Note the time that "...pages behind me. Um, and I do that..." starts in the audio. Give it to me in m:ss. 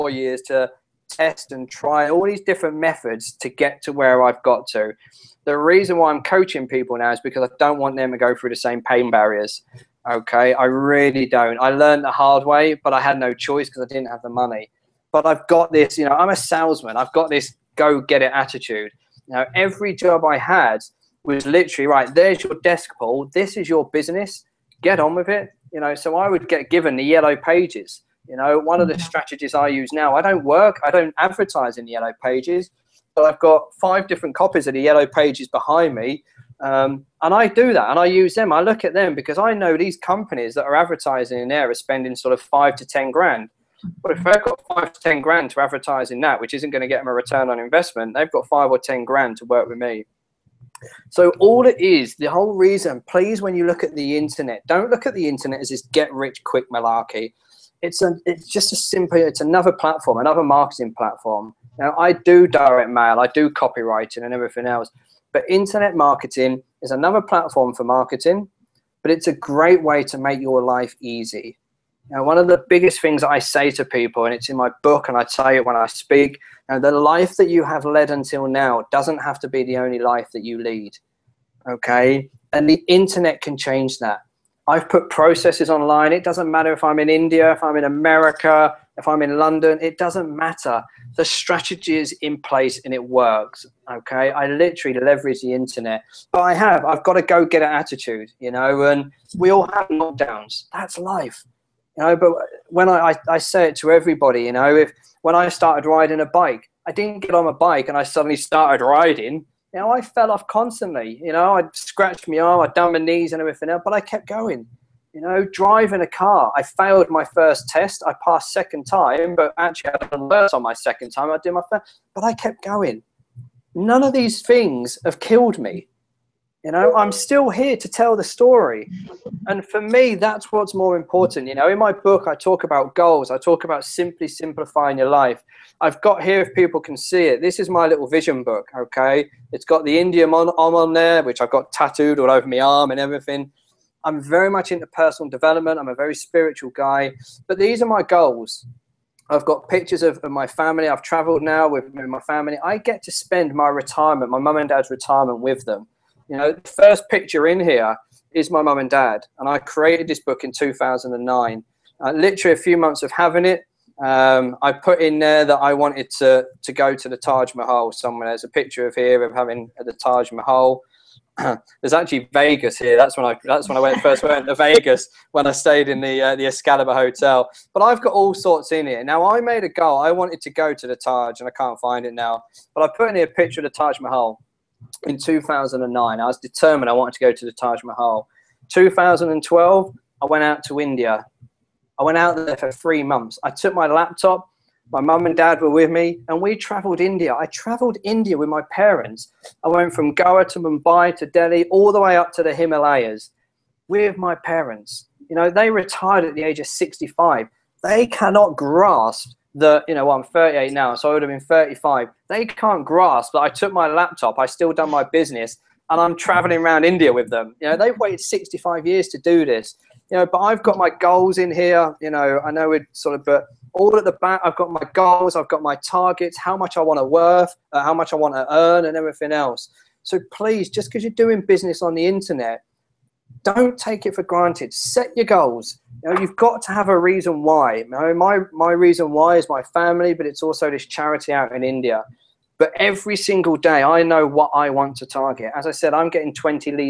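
0:35.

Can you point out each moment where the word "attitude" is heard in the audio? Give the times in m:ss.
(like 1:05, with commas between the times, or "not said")
0:18, 1:37.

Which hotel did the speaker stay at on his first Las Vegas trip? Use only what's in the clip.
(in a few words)
Excalibur Hotel.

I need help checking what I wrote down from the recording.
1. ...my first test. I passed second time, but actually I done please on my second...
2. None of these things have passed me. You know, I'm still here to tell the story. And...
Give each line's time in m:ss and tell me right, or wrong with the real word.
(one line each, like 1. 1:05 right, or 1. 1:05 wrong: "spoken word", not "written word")
1. 1:57 wrong: "worse", not "please"
2. 2:03 wrong: "killed", not "passed".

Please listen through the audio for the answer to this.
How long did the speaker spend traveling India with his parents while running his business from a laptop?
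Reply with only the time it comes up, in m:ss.
3:12.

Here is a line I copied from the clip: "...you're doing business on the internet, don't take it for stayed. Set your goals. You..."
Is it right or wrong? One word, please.
wrong.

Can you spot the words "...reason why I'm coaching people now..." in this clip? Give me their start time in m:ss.
0:05.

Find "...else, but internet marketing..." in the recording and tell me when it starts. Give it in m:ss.
1:04.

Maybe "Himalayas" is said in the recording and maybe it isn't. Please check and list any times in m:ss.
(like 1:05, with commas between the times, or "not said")
3:22.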